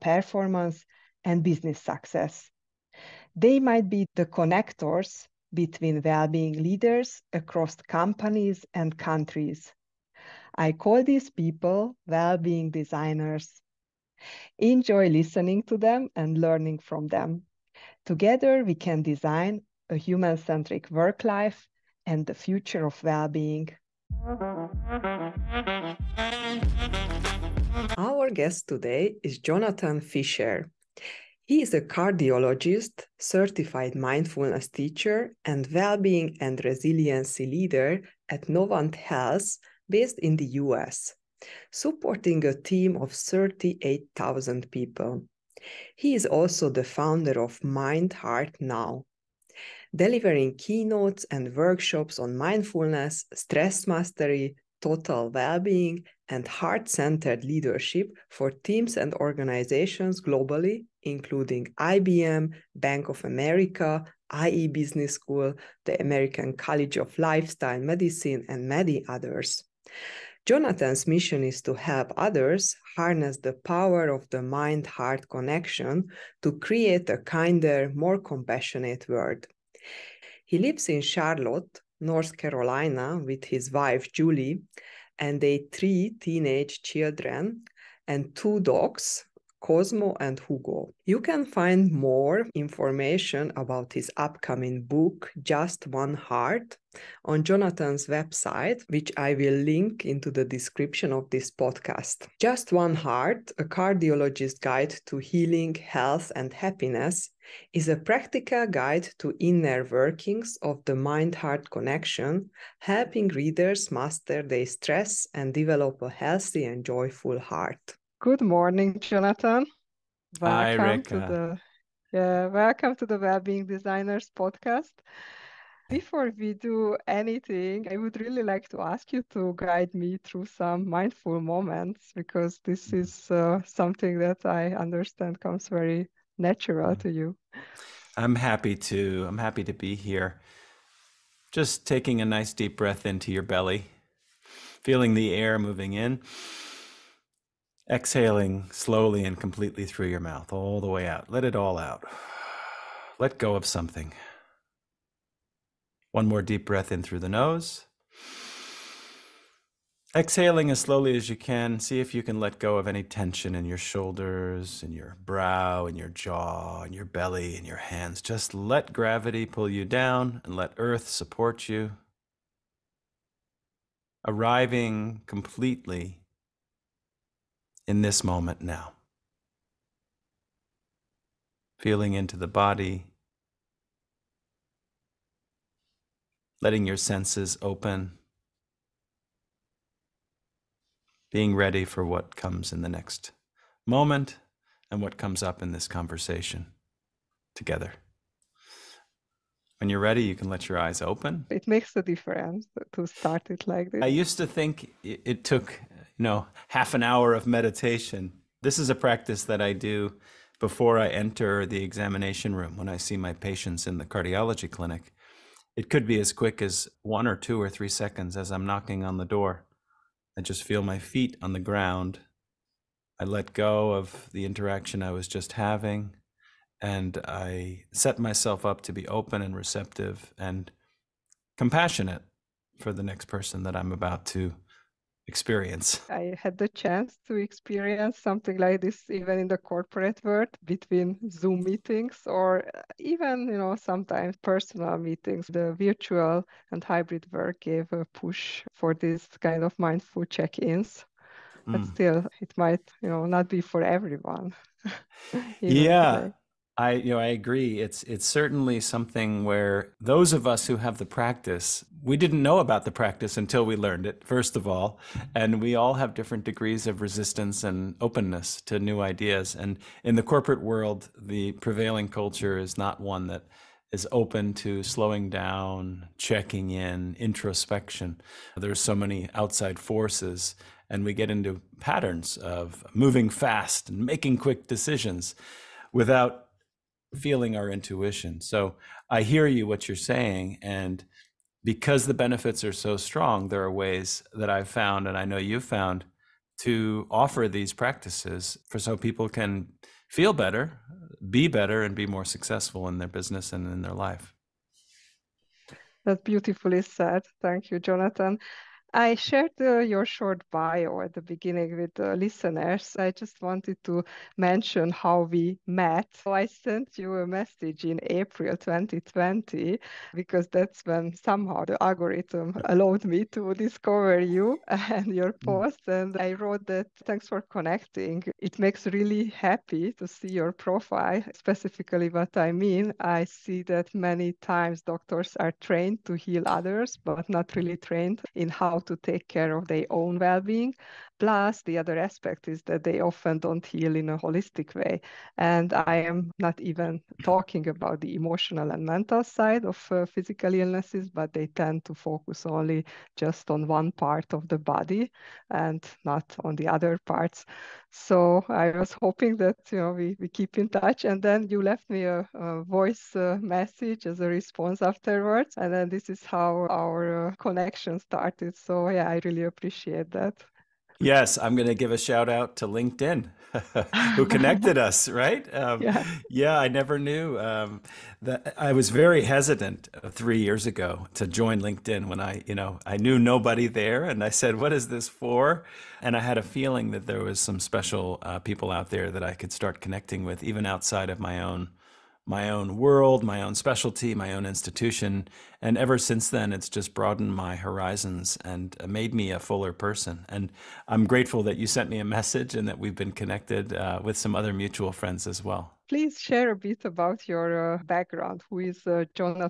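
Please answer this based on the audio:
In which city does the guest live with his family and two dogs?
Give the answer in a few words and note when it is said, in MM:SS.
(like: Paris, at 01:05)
Charlotte, at 01:21.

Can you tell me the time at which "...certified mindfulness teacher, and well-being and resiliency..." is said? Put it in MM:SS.
00:33.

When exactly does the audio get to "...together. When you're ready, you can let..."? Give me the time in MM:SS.
03:17.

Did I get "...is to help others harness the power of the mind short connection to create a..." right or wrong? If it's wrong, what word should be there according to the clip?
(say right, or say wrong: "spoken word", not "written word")
wrong: "heart", not "short".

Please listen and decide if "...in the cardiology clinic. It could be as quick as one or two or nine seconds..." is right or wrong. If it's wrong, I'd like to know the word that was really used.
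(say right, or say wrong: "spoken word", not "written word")
wrong: "three", not "nine".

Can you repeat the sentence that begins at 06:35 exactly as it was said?
And ever since then, it's just broadened my horizons and uh, made me a fuller person.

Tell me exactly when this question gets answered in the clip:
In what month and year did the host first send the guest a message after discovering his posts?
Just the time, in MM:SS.
05:18.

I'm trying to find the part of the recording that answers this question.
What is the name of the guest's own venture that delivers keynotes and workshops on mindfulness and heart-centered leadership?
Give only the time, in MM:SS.
00:47.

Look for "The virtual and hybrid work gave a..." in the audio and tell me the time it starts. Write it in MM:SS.
04:05.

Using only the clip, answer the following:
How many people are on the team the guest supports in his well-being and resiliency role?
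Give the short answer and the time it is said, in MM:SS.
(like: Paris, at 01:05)
38,000, at 00:43.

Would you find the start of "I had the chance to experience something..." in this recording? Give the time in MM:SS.
03:56.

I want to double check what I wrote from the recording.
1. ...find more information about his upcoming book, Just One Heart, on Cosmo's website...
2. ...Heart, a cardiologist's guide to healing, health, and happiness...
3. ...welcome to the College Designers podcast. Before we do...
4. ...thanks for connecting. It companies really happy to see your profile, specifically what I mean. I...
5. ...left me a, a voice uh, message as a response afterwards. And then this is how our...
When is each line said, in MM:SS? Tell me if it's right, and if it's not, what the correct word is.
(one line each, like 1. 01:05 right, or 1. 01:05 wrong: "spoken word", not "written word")
1. 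01:31 wrong: "Jonathan", not "Cosmo"
2. 01:42 right
3. 02:02 wrong: "Wellbeing", not "College"
4. 05:27 wrong: "makes", not "companies"
5. 06:01 right.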